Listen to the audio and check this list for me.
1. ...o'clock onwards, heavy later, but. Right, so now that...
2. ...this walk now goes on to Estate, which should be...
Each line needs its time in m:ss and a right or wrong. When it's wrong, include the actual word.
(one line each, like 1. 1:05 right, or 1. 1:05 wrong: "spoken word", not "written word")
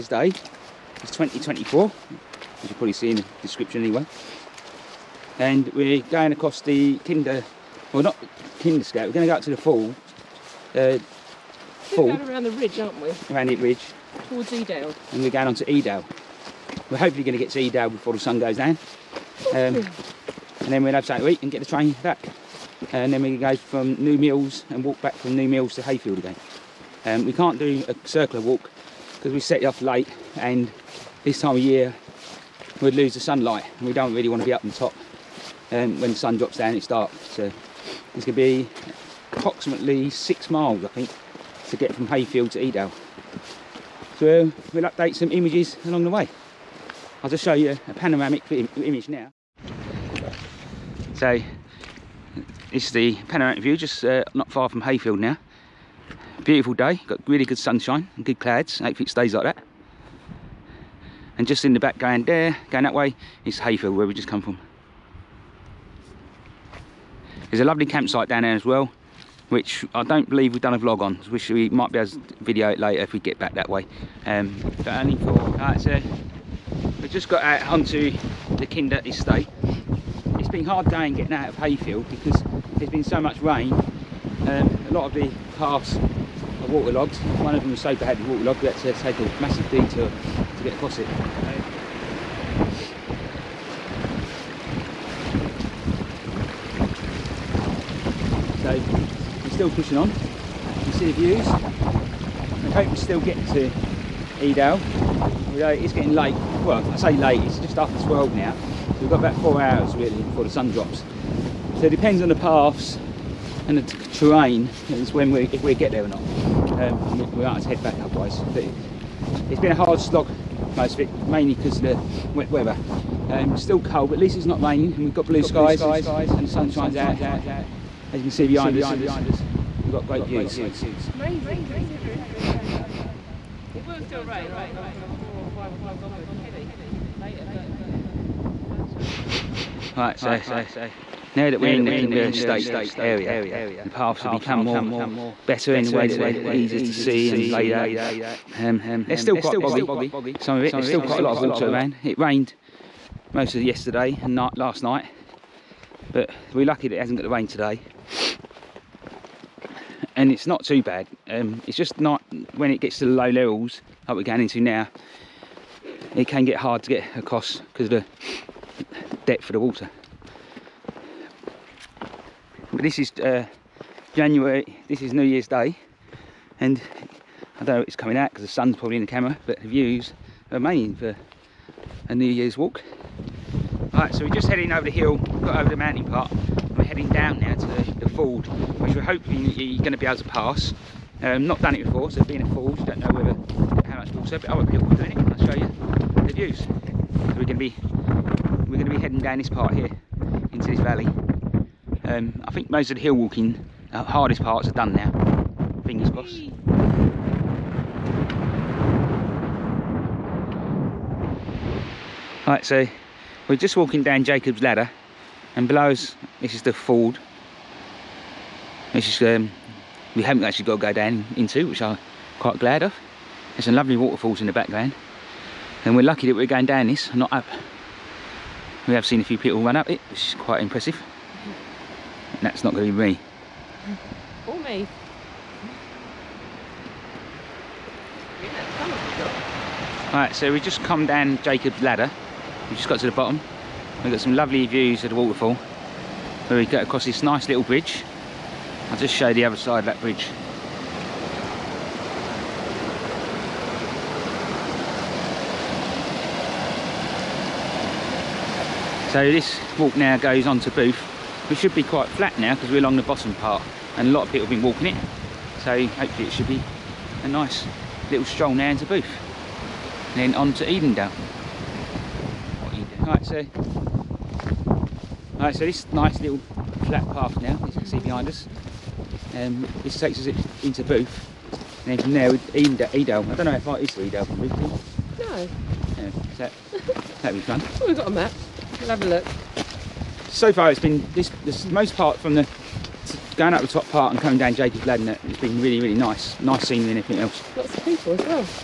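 1. 2:15 right
2. 4:19 wrong: "Booth", not "Estate".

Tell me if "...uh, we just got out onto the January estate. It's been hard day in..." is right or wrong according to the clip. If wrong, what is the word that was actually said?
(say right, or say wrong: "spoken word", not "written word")
wrong: "Kinder", not "January".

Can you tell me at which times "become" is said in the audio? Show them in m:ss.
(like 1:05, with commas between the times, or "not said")
2:24.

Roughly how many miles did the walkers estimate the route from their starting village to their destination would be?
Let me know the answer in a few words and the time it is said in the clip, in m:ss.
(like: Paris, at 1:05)
6, at 0:40.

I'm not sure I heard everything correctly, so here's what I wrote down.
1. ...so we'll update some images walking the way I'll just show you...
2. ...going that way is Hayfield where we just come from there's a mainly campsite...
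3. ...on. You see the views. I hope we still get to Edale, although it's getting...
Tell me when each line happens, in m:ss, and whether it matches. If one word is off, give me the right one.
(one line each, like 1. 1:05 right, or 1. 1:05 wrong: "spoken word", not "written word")
1. 0:44 wrong: "along", not "walking"
2. 1:02 wrong: "lovely", not "mainly"
3. 1:39 right.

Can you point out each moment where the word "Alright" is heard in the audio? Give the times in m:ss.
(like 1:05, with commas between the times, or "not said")
3:03, 4:00.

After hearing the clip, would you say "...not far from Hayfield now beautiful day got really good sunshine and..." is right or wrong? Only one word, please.
right.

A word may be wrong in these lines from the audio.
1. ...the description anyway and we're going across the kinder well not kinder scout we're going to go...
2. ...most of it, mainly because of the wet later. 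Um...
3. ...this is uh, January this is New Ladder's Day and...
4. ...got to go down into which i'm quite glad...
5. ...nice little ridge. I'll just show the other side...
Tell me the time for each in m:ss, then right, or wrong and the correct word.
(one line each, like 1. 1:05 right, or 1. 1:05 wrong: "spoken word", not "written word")
1. 0:03 right
2. 2:00 wrong: "weather", not "later"
3. 2:52 wrong: "Year", not "Ladder"
4. 3:40 right
5. 4:07 wrong: "bridge", not "ridge".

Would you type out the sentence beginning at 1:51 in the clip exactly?
So it depends on the paths and the terrain is when we, if we get there or not.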